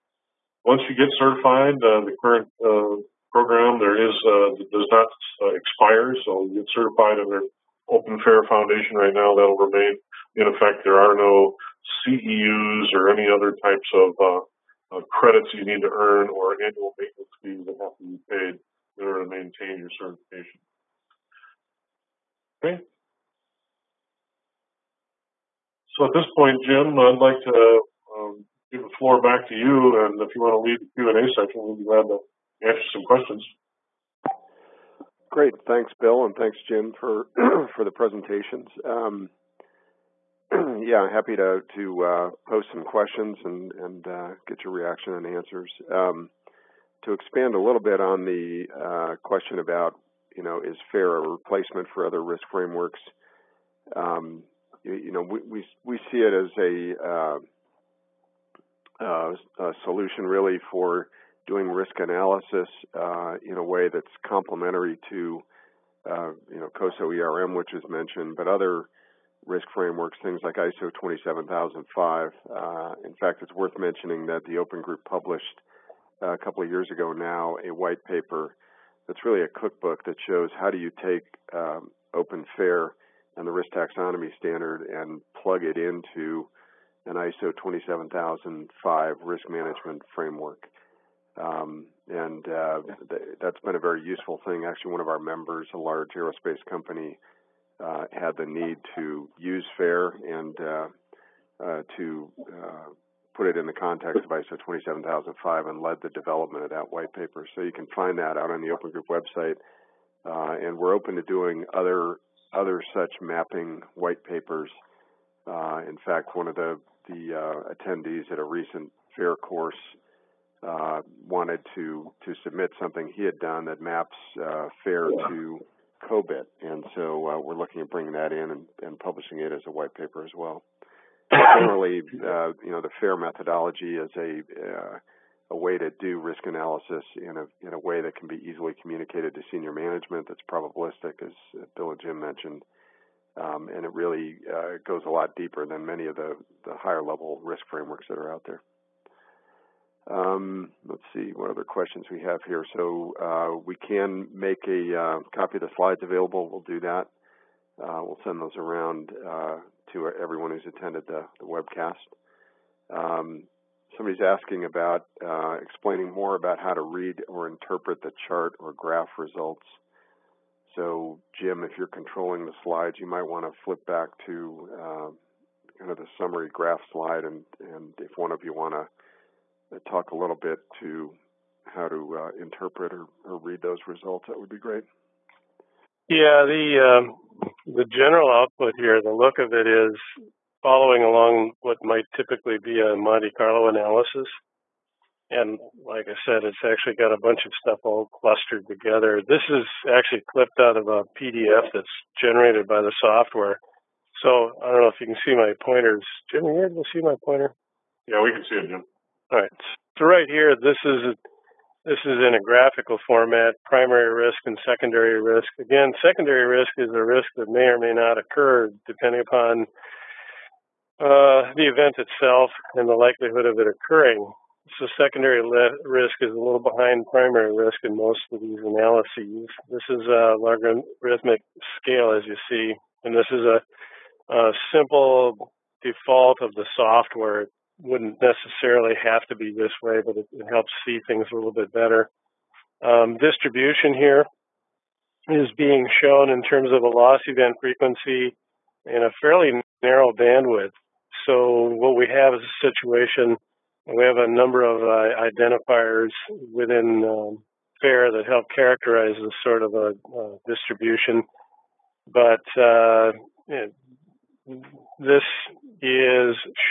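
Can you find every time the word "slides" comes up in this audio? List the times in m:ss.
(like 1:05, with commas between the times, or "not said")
2:35, 2:52, 2:56.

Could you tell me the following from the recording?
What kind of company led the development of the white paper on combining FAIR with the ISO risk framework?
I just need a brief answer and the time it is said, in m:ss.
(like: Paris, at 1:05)
A large aerospace company, at 1:35.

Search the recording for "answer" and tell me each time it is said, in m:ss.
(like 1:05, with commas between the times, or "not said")
0:32, 0:45.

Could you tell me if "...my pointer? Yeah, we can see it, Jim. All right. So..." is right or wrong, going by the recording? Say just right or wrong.
right.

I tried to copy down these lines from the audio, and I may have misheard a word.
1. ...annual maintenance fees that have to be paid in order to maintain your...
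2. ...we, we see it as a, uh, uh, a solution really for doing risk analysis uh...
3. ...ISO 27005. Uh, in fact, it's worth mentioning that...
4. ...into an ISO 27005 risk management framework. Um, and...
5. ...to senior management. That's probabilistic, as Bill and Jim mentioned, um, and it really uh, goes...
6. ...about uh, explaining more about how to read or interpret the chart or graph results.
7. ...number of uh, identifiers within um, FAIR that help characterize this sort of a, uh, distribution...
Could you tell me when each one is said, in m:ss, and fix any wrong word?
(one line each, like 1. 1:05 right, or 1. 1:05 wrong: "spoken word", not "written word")
1. 0:16 right
2. 0:55 right
3. 1:10 right
4. 1:25 right
5. 2:19 right
6. 2:44 right
7. 4:14 right.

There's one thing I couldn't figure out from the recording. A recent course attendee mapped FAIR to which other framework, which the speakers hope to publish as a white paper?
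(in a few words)
COBIT.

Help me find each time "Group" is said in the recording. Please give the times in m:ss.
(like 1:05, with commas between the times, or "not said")
1:14, 1:48.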